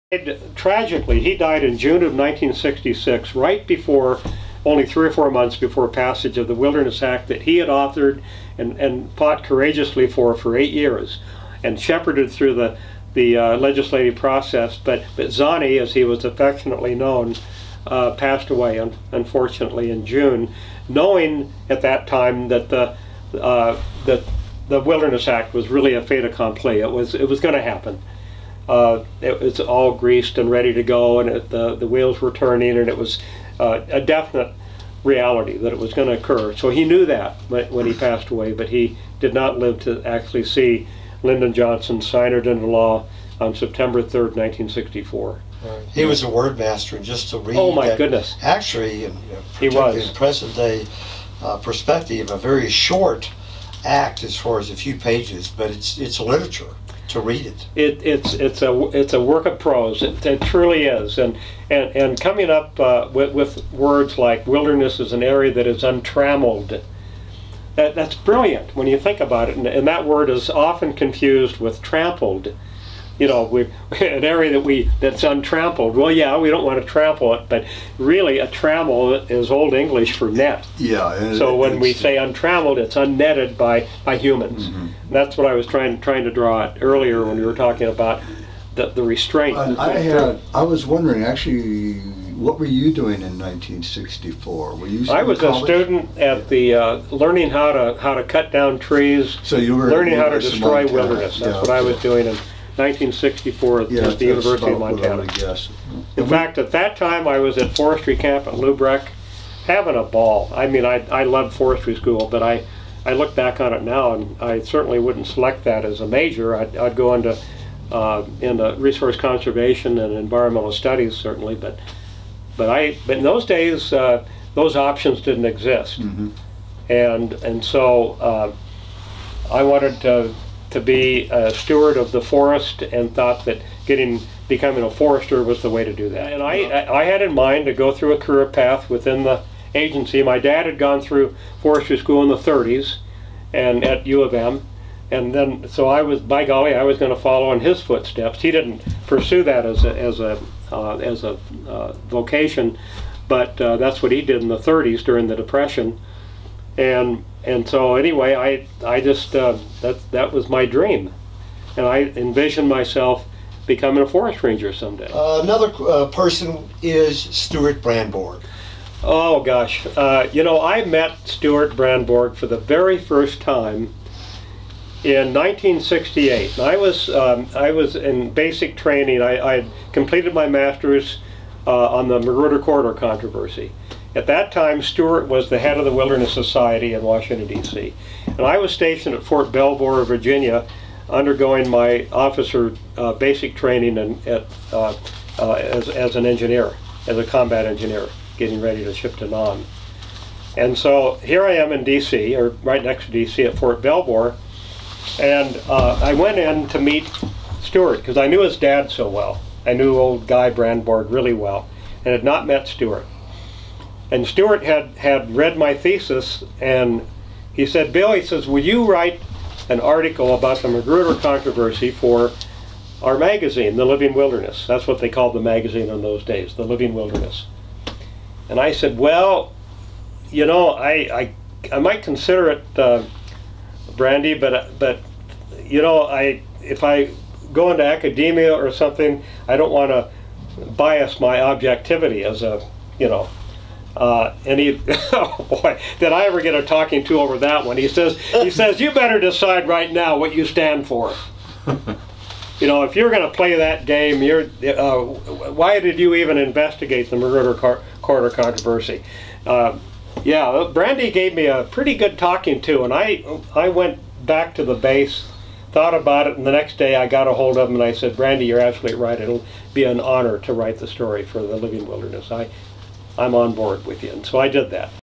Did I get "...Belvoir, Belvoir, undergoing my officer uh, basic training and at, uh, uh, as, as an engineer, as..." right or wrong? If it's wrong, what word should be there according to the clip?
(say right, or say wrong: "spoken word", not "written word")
wrong: "Virginia", not "Belvoir".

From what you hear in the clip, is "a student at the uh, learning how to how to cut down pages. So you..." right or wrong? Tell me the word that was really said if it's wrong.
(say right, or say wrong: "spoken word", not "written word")
wrong: "trees", not "pages".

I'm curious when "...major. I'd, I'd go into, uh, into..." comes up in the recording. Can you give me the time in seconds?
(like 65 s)
116 s.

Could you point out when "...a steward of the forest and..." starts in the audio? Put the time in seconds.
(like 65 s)
131 s.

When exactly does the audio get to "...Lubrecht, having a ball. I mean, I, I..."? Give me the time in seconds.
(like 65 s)
108 s.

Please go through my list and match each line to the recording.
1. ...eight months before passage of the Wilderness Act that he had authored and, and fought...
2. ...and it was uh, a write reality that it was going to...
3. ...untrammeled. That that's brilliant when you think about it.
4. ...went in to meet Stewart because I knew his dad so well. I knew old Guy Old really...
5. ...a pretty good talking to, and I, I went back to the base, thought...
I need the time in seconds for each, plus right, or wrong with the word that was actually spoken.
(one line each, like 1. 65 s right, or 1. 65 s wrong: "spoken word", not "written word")
1. 5 s wrong: "four", not "eight"
2. 32 s wrong: "definite", not "write"
3. 65 s right
4. 206 s wrong: "Brandborg", not "Old"
5. 261 s right.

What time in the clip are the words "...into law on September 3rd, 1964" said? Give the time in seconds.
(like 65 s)
42 s.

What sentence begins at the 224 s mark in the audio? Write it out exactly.
That's what they called the magazine in those days, The Living Wilderness.